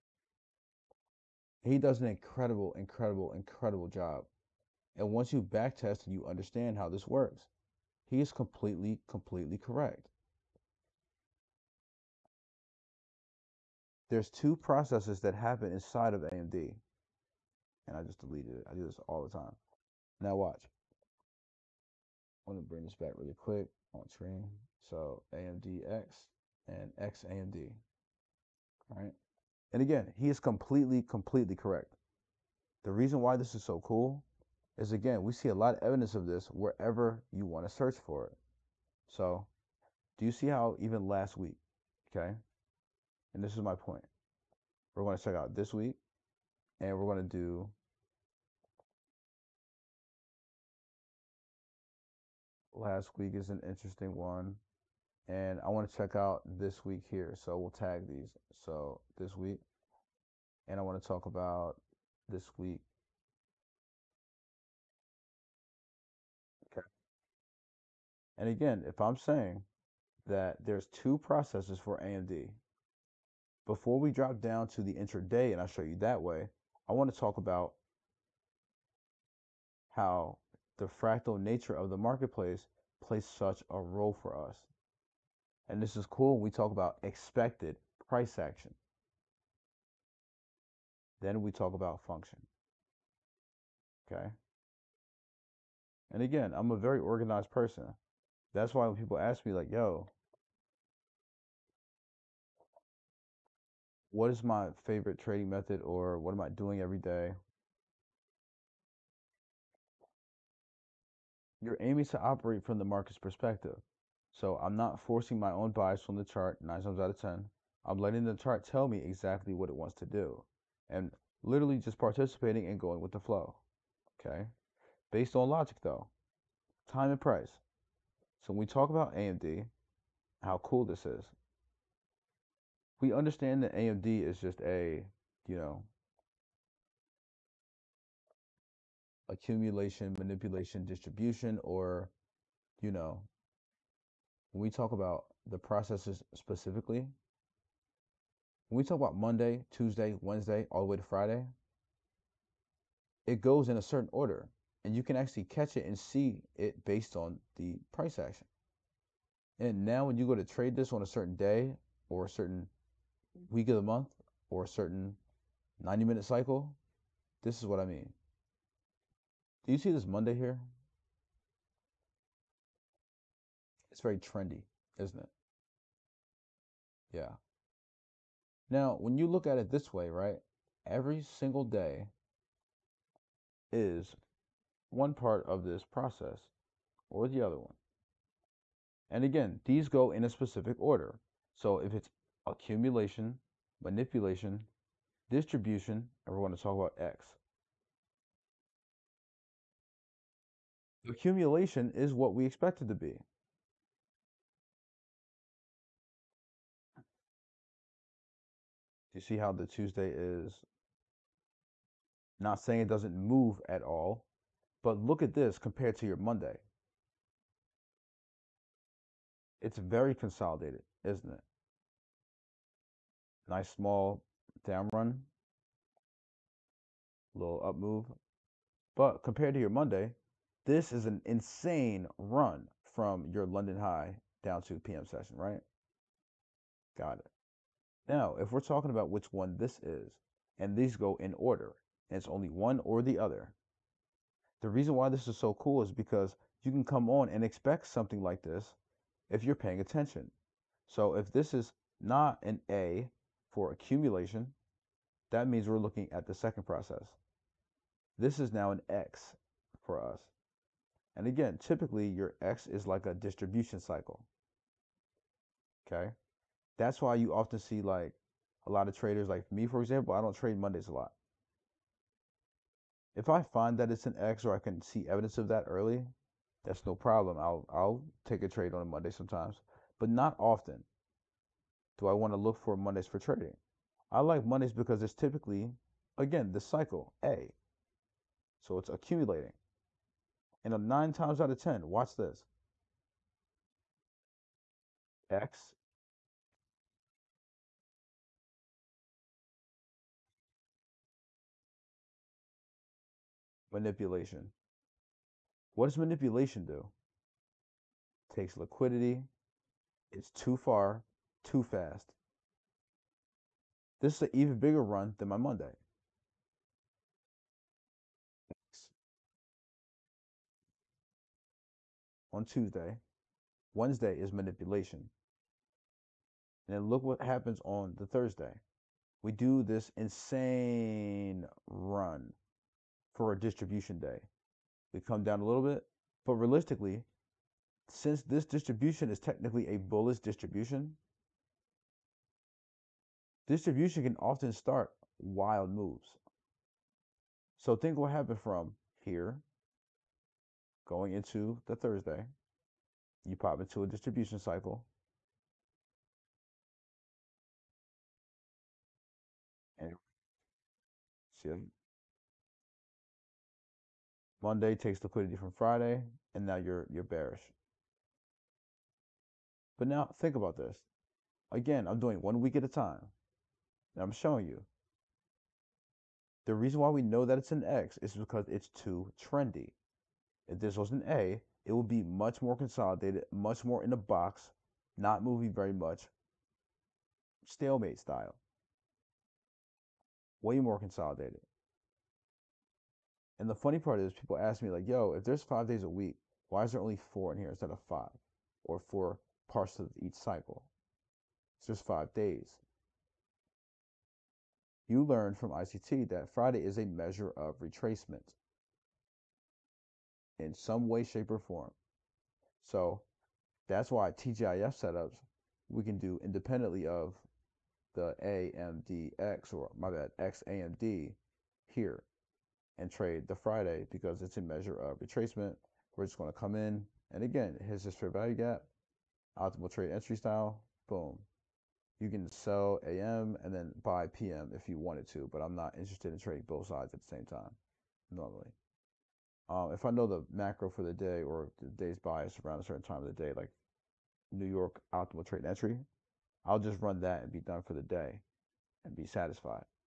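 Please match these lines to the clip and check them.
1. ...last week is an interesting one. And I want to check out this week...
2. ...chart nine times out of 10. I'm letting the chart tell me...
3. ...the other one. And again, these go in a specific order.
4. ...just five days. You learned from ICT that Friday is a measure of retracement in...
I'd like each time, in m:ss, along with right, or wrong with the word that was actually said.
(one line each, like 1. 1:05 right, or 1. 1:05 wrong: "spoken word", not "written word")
1. 0:52 right
2. 1:56 right
3. 3:07 right
4. 6:41 right.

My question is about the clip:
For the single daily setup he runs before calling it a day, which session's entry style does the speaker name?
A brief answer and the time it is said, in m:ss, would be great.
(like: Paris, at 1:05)
New York optimal trade entry, at 7:24.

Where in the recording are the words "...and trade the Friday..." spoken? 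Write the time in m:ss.
7:02.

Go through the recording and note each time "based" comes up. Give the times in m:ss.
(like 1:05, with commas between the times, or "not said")
2:05, 2:36.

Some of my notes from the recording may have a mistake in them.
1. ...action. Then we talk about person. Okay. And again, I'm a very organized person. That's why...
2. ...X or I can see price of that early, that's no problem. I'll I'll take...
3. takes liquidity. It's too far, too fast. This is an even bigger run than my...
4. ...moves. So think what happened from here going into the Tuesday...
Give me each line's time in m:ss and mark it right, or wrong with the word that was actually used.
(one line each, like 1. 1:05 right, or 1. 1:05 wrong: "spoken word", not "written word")
1. 1:28 wrong: "function", not "person"
2. 4:34 wrong: "evidence", not "price"
3. 5:08 right
4. 5:45 wrong: "Thursday", not "Tuesday".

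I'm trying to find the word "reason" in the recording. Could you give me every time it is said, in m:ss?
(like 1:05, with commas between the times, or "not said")
0:32, 4:04, 6:16.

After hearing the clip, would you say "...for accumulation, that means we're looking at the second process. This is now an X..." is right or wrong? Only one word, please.
right.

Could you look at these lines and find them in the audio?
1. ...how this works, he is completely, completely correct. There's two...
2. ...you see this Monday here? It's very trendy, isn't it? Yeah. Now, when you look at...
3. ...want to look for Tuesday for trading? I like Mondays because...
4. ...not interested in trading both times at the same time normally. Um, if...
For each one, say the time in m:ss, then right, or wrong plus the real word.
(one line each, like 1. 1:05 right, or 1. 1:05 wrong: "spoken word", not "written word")
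1. 0:06 right
2. 2:49 right
3. 4:42 wrong: "Mondays", not "Tuesday"
4. 7:15 wrong: "sides", not "times".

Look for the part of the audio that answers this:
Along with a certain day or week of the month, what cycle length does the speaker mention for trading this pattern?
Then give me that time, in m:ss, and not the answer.
2:45.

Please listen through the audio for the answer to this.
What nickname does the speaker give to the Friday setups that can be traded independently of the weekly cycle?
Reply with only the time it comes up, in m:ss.
6:54.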